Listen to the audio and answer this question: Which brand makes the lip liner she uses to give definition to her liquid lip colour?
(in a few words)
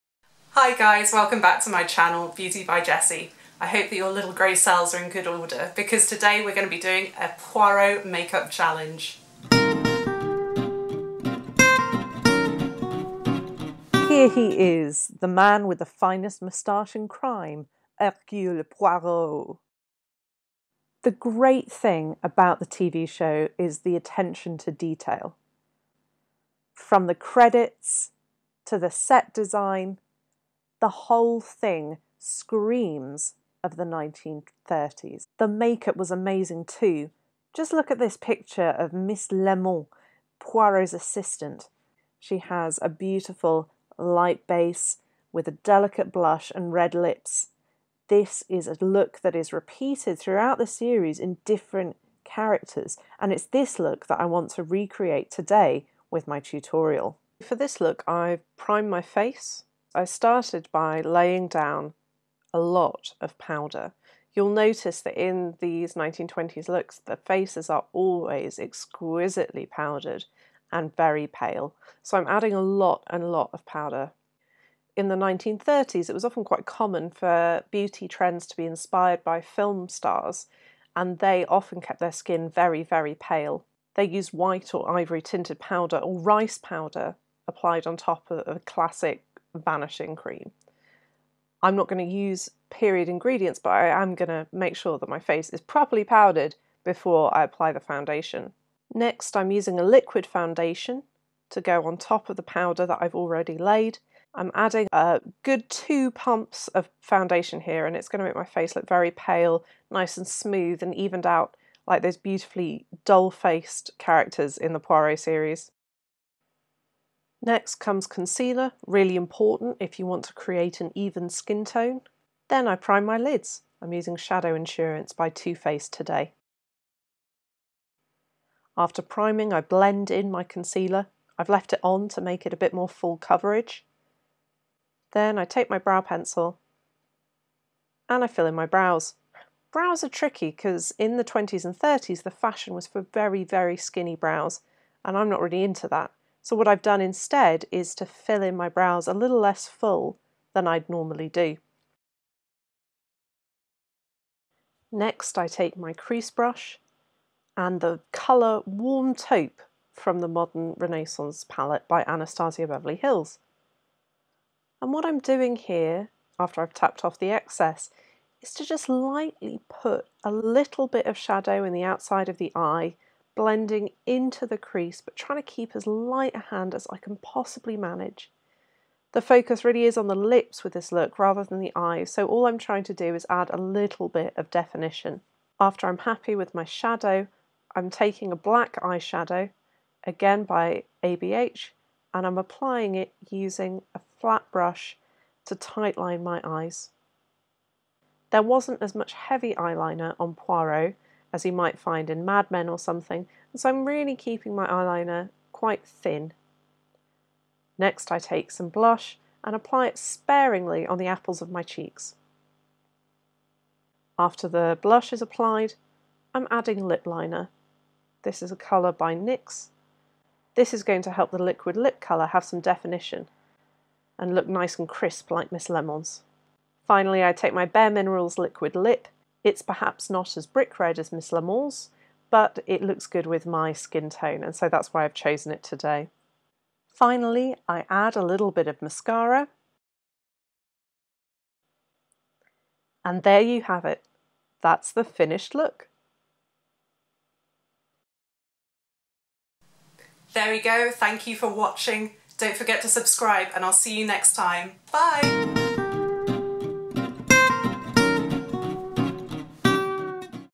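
NYX.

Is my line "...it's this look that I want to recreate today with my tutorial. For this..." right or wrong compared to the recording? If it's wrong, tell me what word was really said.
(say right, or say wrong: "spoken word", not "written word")
right.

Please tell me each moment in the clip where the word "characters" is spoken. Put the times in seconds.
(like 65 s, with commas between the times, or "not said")
52 s, 113 s.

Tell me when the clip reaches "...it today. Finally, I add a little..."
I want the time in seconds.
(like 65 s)
235 s.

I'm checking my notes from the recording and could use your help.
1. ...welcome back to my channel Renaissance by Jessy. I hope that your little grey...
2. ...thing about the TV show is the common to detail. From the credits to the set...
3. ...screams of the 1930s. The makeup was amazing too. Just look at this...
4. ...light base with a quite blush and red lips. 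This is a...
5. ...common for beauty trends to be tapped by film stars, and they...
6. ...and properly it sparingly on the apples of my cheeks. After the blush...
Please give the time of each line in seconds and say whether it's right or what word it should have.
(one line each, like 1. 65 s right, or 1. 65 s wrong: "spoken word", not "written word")
1. 1 s wrong: "Beauty", not "Renaissance"
2. 21 s wrong: "attention", not "common"
3. 32 s right
4. 43 s wrong: "delicate", not "quite"
5. 76 s wrong: "inspired", not "tapped"
6. 209 s wrong: "apply", not "properly".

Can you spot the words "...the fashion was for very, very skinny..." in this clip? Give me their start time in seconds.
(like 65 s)
142 s.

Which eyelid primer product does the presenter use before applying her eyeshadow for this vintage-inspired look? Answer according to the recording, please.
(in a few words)
Shadow Insurance.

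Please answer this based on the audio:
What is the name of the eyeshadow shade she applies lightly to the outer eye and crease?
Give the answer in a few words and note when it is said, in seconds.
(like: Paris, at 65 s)
Warm Taupe, at 158 s.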